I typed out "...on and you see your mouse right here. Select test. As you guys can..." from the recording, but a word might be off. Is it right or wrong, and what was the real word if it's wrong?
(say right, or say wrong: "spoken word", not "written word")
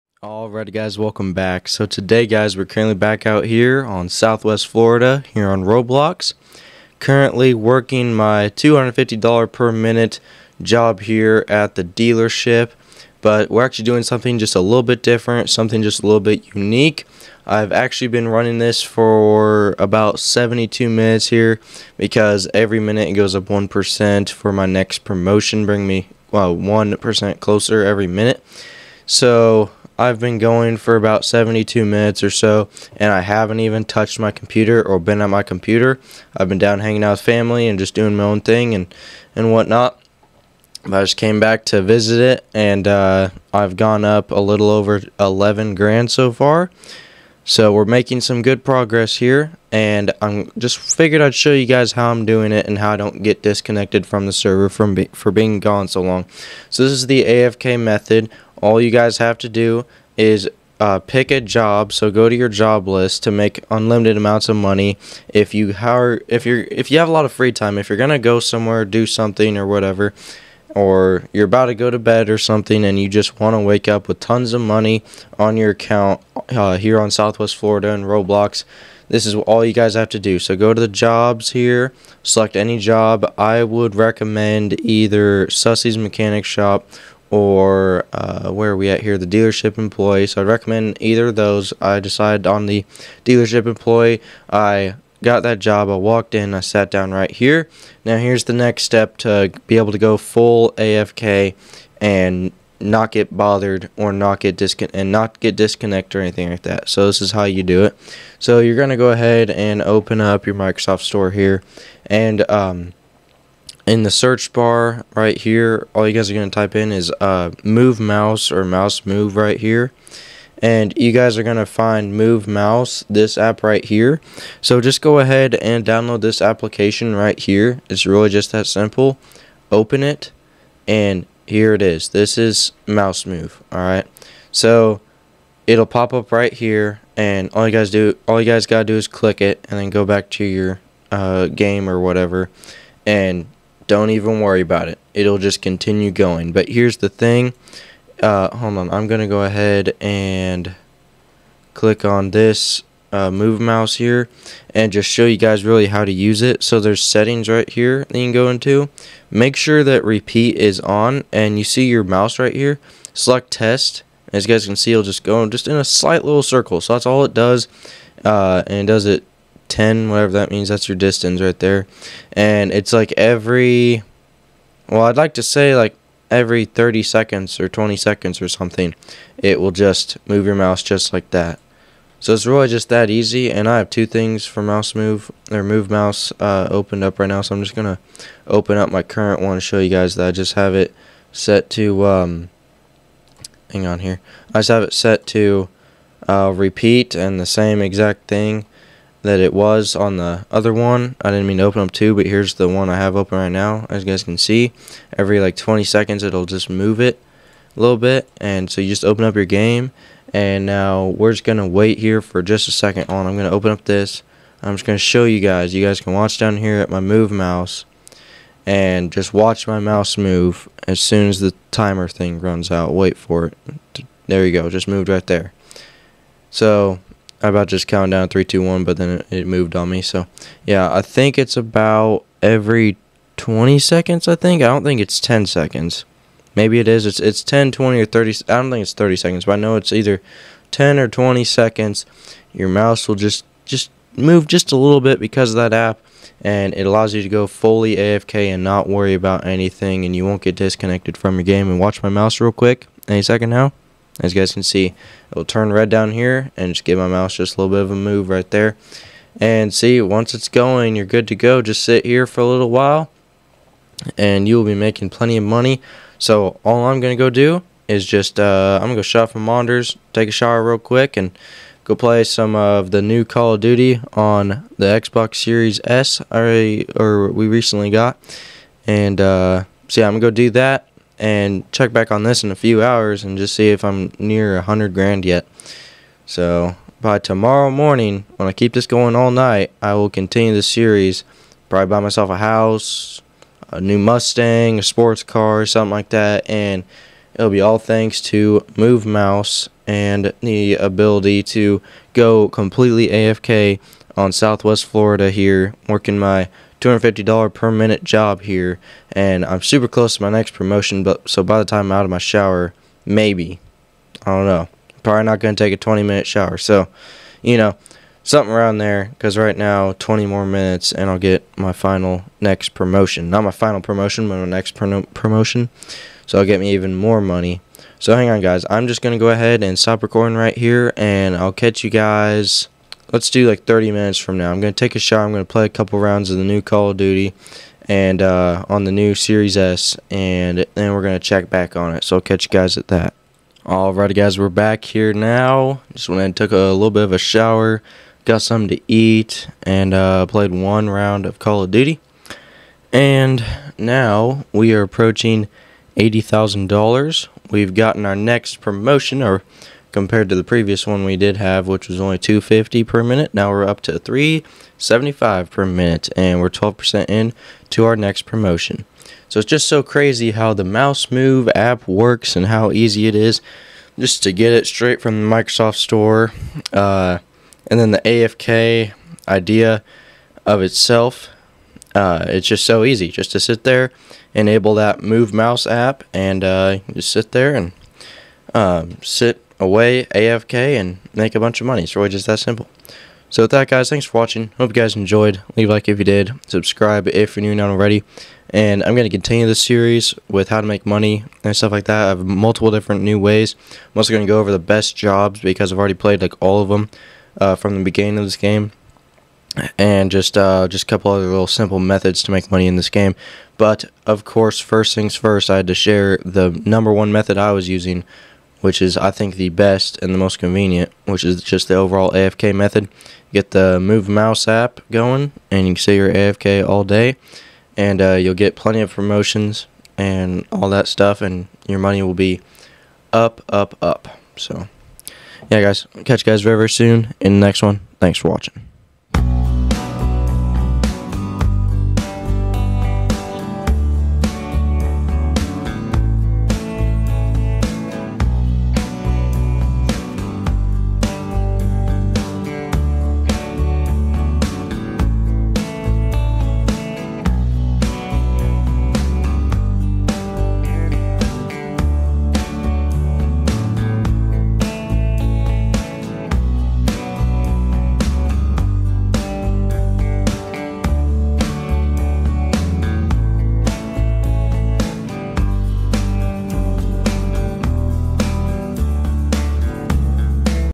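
right.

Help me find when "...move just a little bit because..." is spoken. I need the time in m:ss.
4:04.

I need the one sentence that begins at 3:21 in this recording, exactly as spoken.
I didn't mean to open up two, but here's the one I have open right now.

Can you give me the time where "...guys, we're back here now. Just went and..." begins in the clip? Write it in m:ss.
5:44.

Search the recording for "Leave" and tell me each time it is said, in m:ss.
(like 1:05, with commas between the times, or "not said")
6:35.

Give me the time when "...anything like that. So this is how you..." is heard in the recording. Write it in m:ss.
1:46.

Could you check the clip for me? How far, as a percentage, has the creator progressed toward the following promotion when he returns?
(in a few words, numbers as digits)
12%.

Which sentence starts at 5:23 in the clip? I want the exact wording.
Not my final promotion, but my next pro promotion.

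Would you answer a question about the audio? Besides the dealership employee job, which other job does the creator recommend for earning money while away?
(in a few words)
Sussy's Mechanic Shop.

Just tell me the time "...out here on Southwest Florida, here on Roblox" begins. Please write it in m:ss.
0:03.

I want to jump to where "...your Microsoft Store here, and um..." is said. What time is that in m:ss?
1:50.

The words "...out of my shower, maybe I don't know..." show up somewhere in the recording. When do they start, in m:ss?
5:11.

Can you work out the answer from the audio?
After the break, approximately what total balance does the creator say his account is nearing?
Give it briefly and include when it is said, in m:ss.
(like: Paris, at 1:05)
$80,000, at 5:55.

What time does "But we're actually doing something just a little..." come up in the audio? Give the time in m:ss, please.
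0:13.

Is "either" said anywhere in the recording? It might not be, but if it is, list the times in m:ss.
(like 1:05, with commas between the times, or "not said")
1:24, 1:31, 3:59.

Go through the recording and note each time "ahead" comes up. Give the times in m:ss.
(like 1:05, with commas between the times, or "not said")
1:49, 2:05, 2:29, 5:29.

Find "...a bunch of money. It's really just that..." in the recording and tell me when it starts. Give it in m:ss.
6:31.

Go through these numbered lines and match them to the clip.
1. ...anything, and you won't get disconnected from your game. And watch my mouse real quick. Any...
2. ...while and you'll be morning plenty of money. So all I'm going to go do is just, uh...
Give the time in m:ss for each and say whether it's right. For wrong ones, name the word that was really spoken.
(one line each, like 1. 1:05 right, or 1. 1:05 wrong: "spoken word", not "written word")
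1. 4:09 right
2. 4:22 wrong: "making", not "morning".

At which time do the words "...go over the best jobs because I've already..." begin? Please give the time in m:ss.
6:44.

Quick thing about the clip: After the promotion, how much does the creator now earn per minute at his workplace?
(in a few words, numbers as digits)
375.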